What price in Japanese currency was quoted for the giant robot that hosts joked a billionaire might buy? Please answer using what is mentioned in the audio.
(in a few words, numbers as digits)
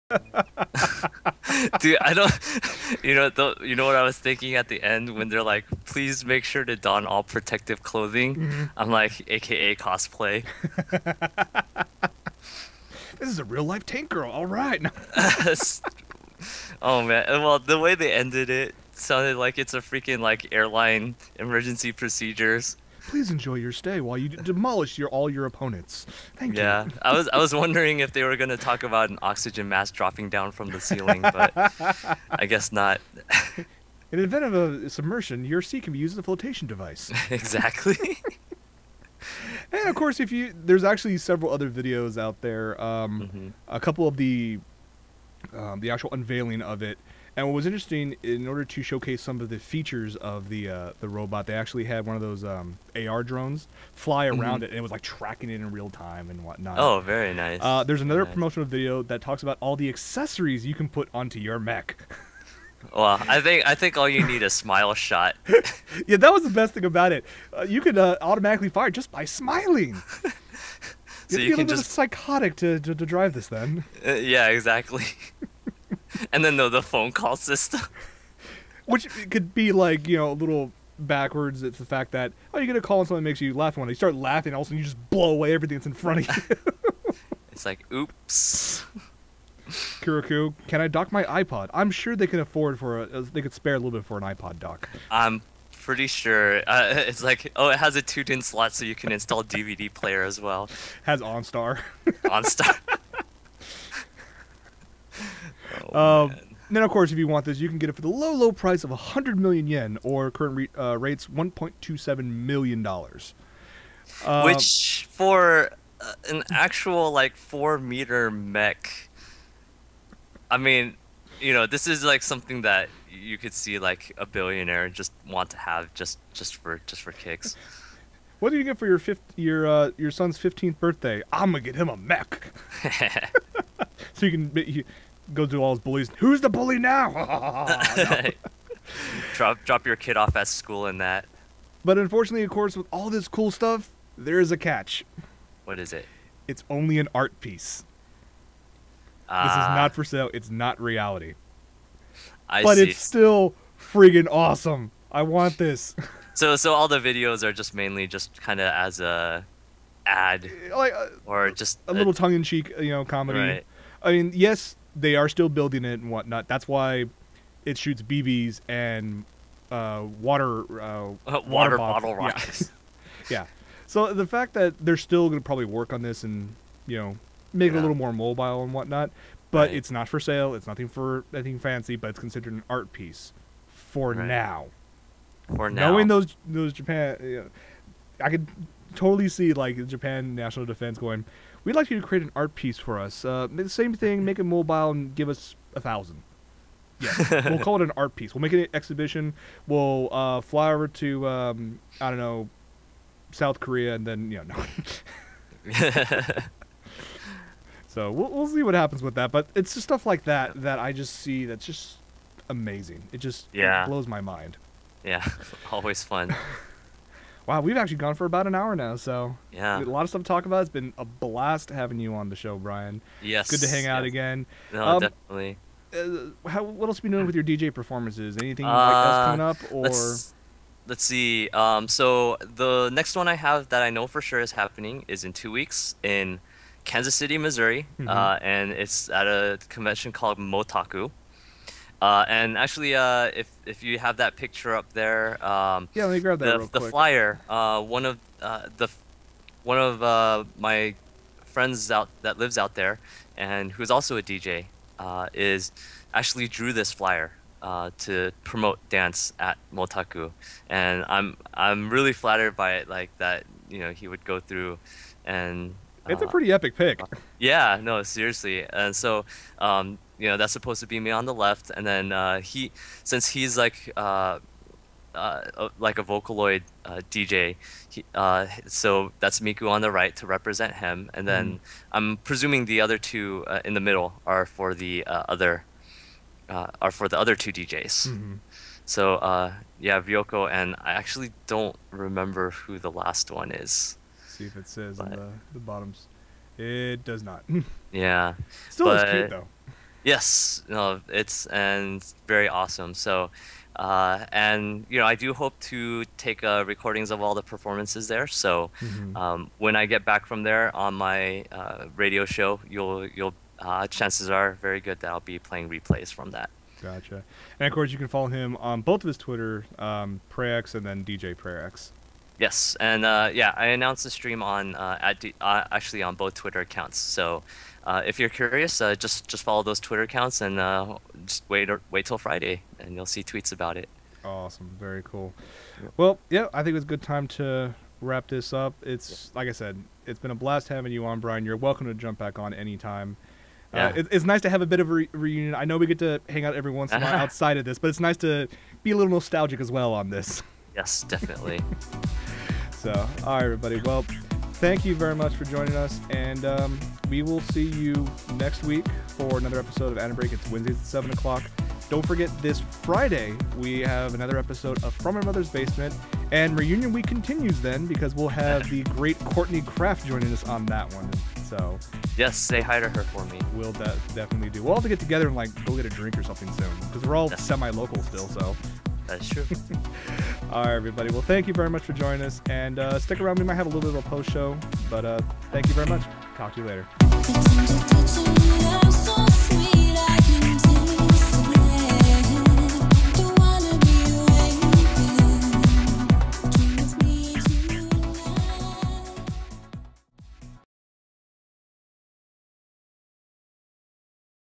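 100 million yen.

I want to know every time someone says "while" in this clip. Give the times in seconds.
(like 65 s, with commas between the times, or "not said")
23 s, 347 s.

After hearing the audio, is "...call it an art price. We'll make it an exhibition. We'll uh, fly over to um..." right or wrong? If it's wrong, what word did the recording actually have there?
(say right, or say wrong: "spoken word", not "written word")
wrong: "piece", not "price".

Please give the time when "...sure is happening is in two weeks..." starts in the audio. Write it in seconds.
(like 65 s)
234 s.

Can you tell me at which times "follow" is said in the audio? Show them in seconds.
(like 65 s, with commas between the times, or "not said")
318 s, 329 s.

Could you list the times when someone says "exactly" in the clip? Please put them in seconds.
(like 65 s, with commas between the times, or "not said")
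37 s, 74 s.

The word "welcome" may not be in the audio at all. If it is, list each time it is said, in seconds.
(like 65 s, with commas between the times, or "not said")
341 s.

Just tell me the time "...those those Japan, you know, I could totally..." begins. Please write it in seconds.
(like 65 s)
186 s.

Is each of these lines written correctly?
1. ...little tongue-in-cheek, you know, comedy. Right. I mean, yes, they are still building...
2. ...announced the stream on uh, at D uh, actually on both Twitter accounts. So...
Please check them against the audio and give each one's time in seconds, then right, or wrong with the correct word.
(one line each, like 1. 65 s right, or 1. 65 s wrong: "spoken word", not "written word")
1. 161 s right
2. 323 s right.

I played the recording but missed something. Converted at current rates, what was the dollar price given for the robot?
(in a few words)
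$1.27 million.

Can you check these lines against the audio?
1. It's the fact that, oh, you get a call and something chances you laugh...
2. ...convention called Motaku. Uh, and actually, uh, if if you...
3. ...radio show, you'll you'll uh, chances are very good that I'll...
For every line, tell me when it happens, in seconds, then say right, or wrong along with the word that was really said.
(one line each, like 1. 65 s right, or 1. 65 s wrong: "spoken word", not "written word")
1. 81 s wrong: "makes", not "chances"
2. 239 s right
3. 311 s right.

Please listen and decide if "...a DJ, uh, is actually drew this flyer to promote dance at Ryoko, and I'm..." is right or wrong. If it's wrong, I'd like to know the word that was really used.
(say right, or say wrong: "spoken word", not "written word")
wrong: "Motaku", not "Ryoko".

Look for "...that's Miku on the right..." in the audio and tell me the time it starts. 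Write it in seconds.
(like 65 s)
279 s.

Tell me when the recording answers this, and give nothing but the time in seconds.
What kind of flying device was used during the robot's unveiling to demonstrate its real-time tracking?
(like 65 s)
52 s.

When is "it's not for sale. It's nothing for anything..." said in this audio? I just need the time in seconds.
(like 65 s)
179 s.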